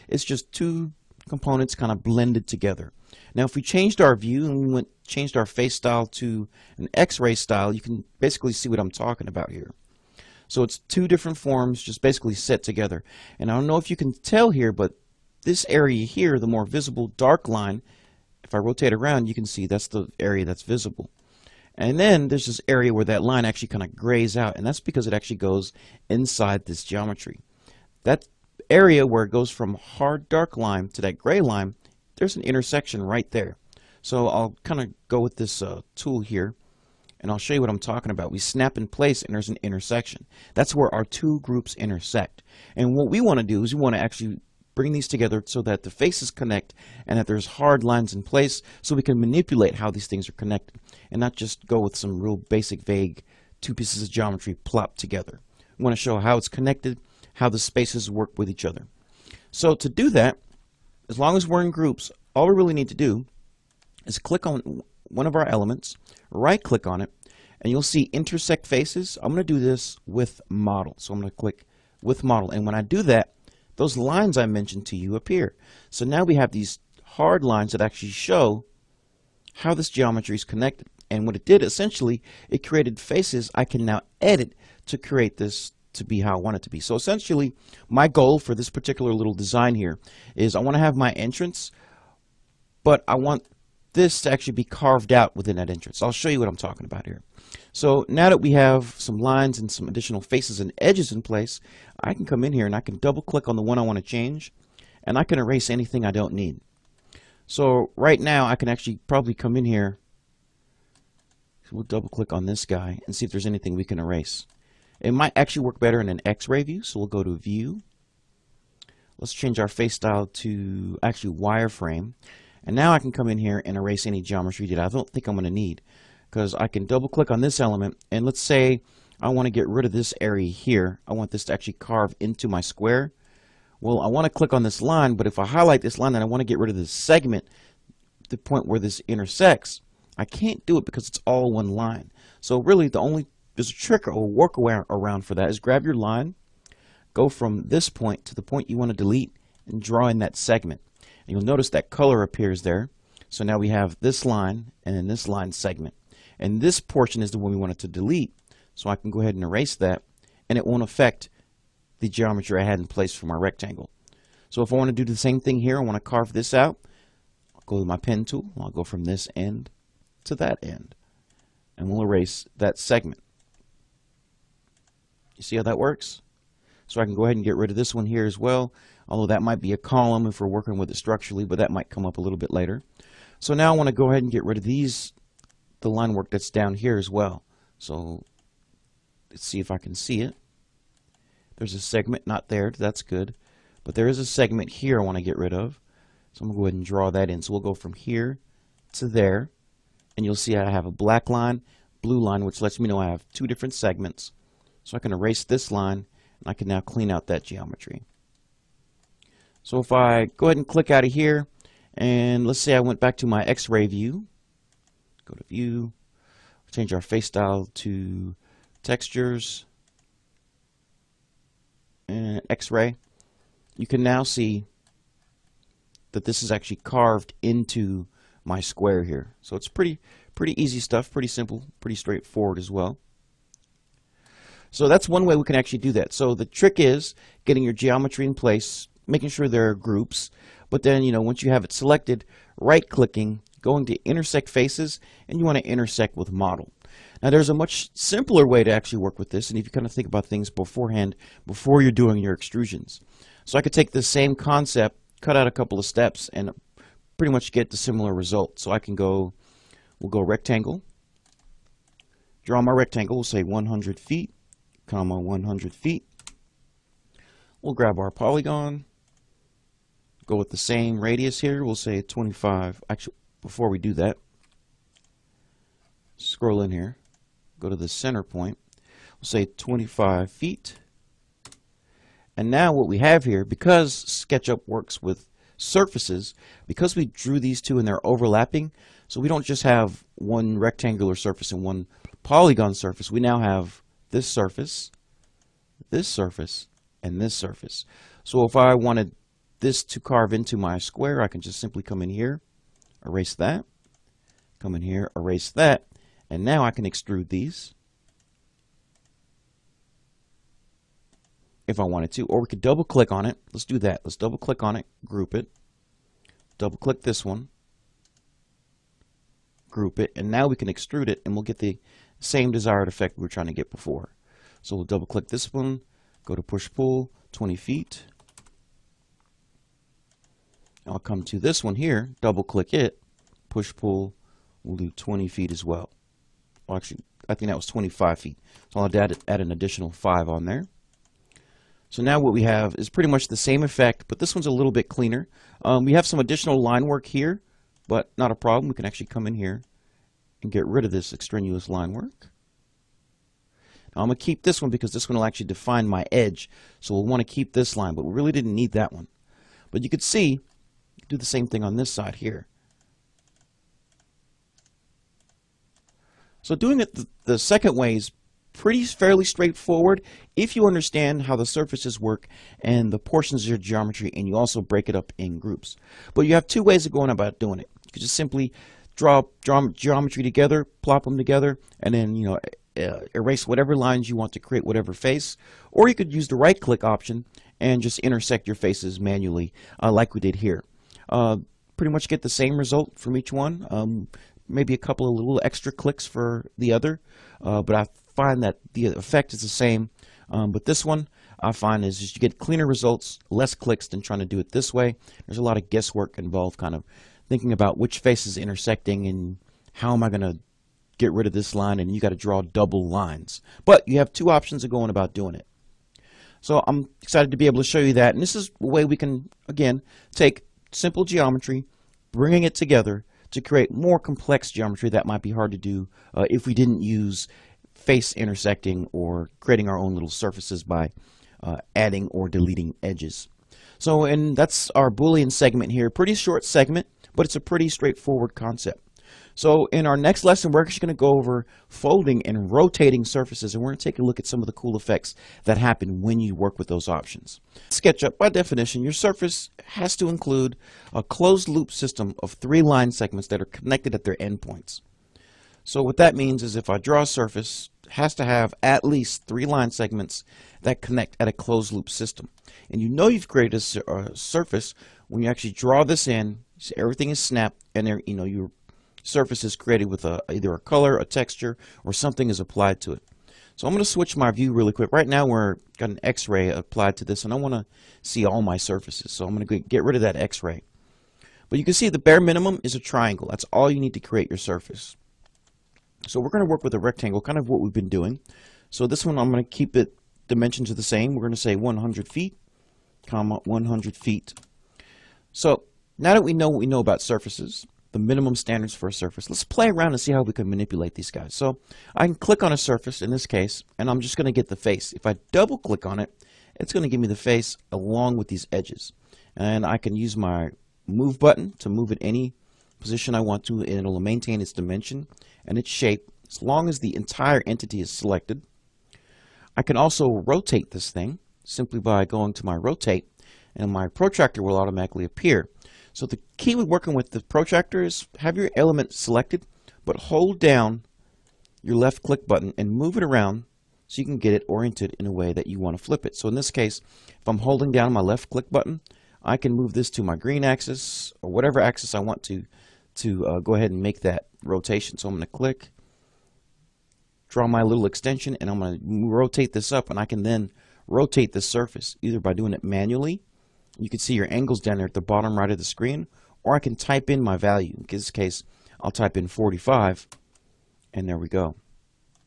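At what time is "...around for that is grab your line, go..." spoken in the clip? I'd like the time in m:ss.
2:24.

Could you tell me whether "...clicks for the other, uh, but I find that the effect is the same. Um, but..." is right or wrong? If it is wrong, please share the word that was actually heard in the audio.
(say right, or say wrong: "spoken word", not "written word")
right.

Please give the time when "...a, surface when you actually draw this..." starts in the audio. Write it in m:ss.
7:43.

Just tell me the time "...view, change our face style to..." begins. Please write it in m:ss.
3:35.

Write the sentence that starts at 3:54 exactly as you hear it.
So that's one way we can actually do that.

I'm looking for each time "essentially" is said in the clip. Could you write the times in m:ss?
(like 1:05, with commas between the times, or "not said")
1:21, 1:26.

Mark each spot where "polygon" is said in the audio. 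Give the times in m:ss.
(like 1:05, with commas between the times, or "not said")
4:28, 4:52.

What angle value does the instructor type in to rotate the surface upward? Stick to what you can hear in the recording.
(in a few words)
45.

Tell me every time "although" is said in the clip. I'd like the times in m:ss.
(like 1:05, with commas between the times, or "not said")
2:59.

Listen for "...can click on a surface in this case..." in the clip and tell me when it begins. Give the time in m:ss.
8:22.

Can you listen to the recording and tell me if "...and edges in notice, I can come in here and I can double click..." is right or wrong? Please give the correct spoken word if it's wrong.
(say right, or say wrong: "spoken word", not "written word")
wrong: "place", not "notice".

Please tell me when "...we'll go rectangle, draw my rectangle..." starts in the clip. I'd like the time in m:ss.
4:19.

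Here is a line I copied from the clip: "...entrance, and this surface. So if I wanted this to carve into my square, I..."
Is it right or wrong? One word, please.
wrong.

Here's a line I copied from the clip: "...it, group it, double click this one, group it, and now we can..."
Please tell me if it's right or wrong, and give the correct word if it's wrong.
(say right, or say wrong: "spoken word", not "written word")
right.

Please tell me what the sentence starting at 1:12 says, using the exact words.
And when I do that, those lines I mentioned to you appear.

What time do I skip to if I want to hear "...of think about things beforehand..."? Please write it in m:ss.
4:09.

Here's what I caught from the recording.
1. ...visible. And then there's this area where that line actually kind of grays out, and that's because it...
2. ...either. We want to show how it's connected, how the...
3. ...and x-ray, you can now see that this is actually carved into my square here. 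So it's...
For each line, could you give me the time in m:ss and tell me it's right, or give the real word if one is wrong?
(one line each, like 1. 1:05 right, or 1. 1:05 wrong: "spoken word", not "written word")
1. 0:20 right
2. 0:54 wrong: "together", not "either"
3. 3:42 right.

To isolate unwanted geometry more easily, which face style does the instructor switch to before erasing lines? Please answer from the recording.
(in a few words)
Wireframe.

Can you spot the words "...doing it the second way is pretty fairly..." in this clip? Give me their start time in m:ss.
6:06.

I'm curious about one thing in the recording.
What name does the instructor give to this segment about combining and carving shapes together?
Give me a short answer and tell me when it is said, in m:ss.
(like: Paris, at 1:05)
Boolean, at 7:14.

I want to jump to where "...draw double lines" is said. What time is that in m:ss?
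6:52.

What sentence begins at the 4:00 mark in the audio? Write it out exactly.
But then, you know, once you have it selected, right clicking, going to intersect faces, and you want to intersect with model.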